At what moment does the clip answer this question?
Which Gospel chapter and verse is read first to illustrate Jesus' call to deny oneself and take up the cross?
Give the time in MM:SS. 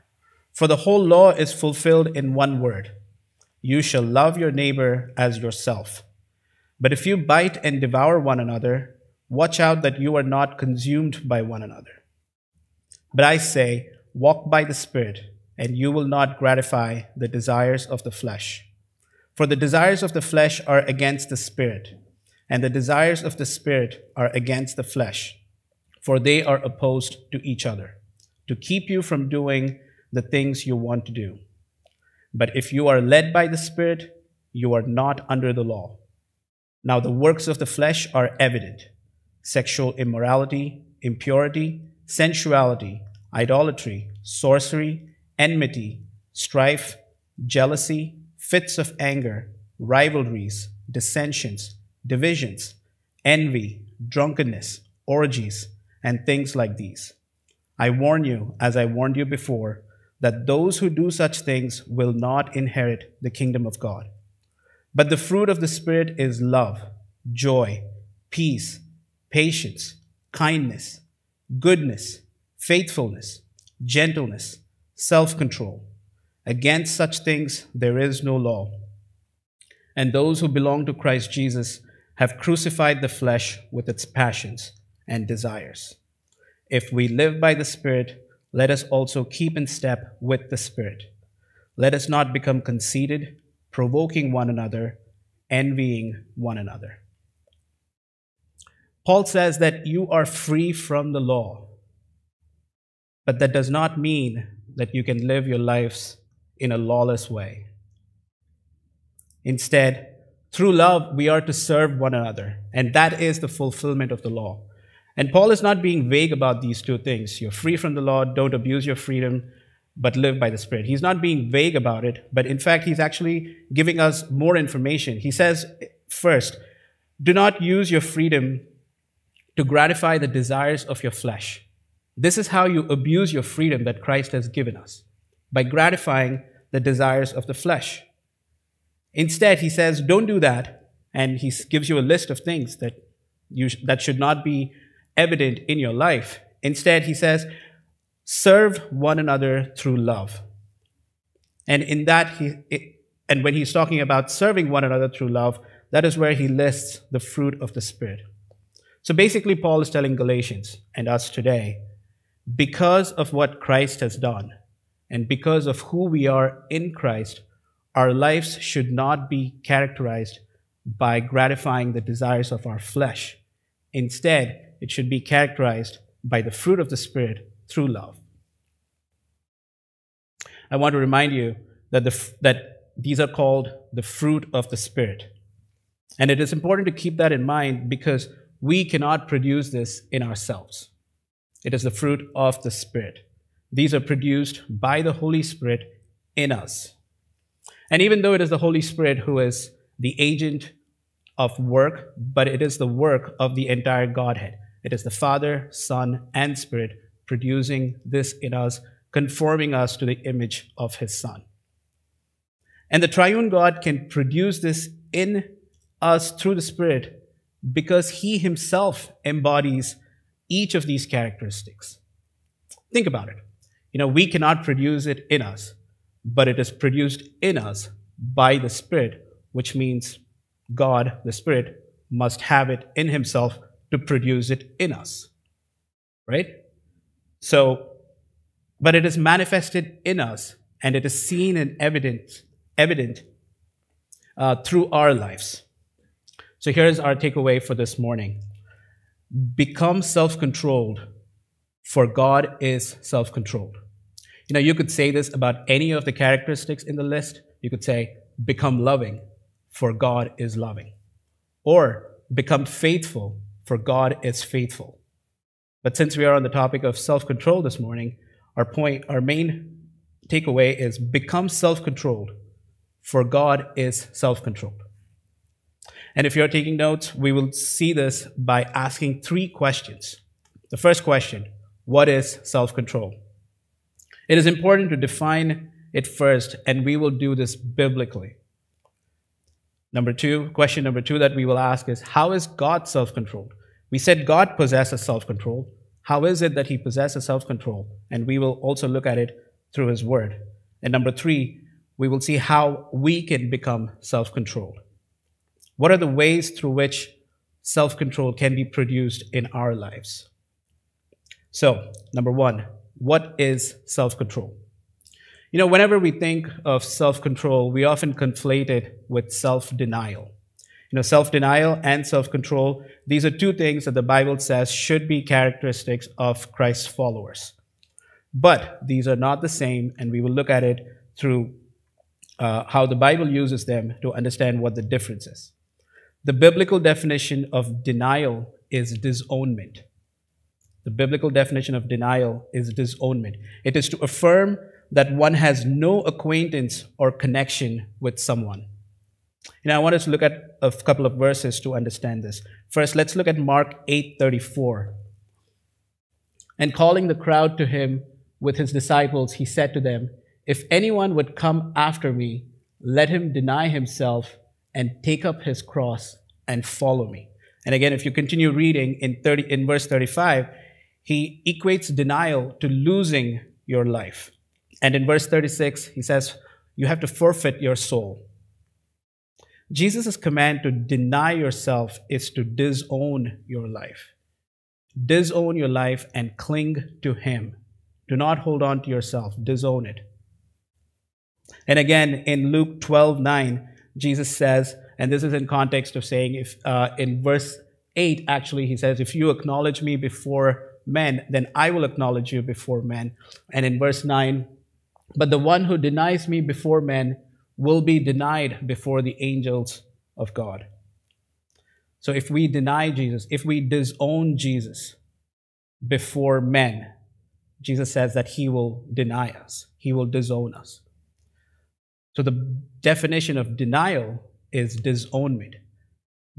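05:53.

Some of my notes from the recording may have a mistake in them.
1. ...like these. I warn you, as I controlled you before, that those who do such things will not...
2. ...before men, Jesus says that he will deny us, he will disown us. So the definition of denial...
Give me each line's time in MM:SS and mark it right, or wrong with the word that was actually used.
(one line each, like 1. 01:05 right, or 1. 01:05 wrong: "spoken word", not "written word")
1. 00:56 wrong: "warned", not "controlled"
2. 06:55 right.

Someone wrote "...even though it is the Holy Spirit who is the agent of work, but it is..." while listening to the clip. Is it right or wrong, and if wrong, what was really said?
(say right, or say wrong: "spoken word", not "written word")
right.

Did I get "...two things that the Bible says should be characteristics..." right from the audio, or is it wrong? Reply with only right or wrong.
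right.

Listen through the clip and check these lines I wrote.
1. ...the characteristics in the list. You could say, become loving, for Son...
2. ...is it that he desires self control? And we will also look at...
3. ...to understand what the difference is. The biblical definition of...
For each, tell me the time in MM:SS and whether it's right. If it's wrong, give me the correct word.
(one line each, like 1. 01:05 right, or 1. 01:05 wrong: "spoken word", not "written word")
1. 04:16 wrong: "God", not "Son"
2. 04:56 wrong: "possesses", not "desires"
3. 05:34 right.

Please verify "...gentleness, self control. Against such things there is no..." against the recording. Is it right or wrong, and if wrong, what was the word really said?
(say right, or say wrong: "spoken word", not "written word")
right.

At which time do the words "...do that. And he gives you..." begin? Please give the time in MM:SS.
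02:20.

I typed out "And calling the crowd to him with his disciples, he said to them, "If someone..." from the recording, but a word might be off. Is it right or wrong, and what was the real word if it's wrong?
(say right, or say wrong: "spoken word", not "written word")
wrong: "anyone", not "someone".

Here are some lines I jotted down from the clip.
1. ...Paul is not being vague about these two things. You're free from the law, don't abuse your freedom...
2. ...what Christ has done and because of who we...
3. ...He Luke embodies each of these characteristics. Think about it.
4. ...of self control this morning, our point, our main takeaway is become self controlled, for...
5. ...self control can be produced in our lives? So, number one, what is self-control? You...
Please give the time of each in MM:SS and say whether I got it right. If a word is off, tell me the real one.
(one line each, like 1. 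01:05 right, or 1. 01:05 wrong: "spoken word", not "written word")
1. 01:55 right
2. 02:43 right
3. 03:38 wrong: "Himself", not "Luke"
4. 04:26 right
5. 05:07 right.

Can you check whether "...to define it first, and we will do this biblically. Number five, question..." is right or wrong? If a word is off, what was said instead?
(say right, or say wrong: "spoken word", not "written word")
wrong: "two", not "five".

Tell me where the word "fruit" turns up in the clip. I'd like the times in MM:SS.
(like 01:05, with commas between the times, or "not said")
01:05, 02:37, 02:56, 03:04, 03:11.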